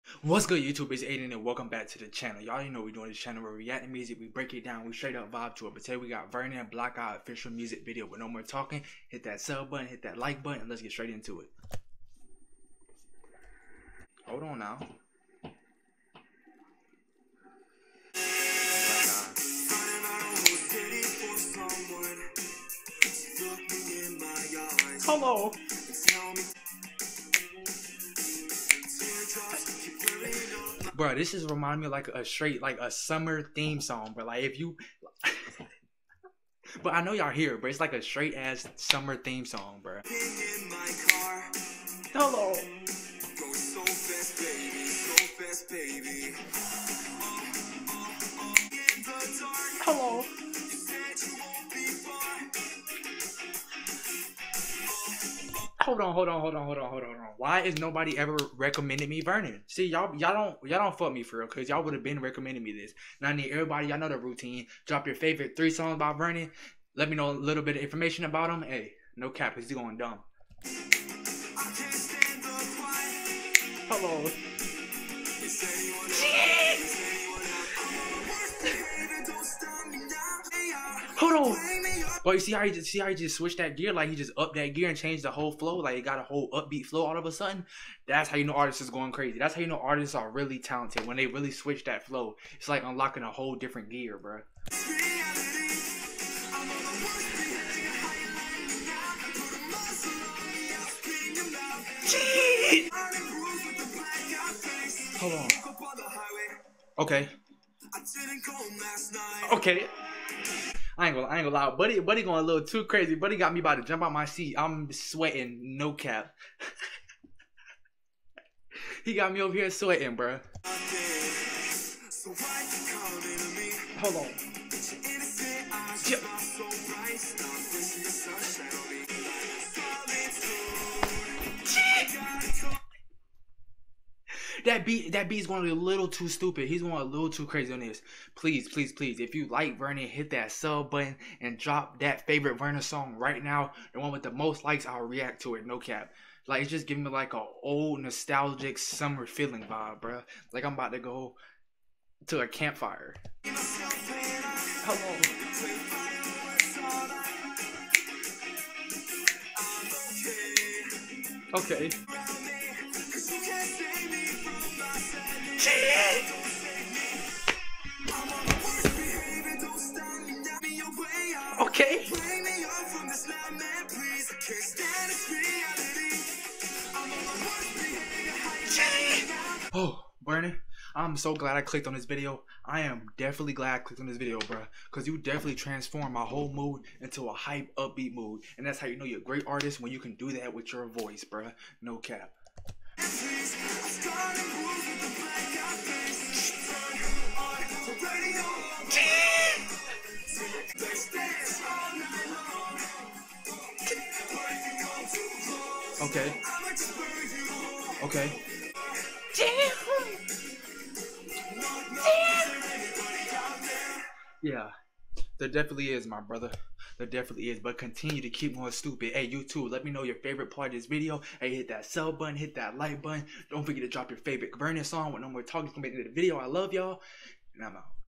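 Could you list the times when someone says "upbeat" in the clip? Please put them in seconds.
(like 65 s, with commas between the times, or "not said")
86 s, 187 s.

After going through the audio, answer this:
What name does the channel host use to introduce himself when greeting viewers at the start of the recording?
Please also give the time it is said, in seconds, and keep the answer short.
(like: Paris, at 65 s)
Aiden, at 1 s.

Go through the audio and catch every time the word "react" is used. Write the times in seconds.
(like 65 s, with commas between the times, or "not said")
3 s, 145 s.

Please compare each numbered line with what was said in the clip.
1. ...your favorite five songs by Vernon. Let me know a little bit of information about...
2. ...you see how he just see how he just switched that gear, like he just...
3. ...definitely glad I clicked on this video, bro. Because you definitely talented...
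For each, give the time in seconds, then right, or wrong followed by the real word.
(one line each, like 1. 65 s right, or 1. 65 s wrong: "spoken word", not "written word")
1. 65 s wrong: "three", not "five"
2. 82 s right
3. 183 s wrong: "transformed", not "talented".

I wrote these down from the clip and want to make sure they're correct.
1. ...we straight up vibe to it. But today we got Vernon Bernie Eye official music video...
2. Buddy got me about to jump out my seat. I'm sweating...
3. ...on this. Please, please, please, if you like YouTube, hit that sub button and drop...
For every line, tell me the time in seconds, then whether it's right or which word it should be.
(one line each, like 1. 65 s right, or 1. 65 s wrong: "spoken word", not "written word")
1. 4 s wrong: "Black", not "Bernie"
2. 113 s right
3. 137 s wrong: "Vernon", not "YouTube".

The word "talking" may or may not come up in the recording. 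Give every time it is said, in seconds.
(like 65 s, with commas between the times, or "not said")
8 s, 225 s.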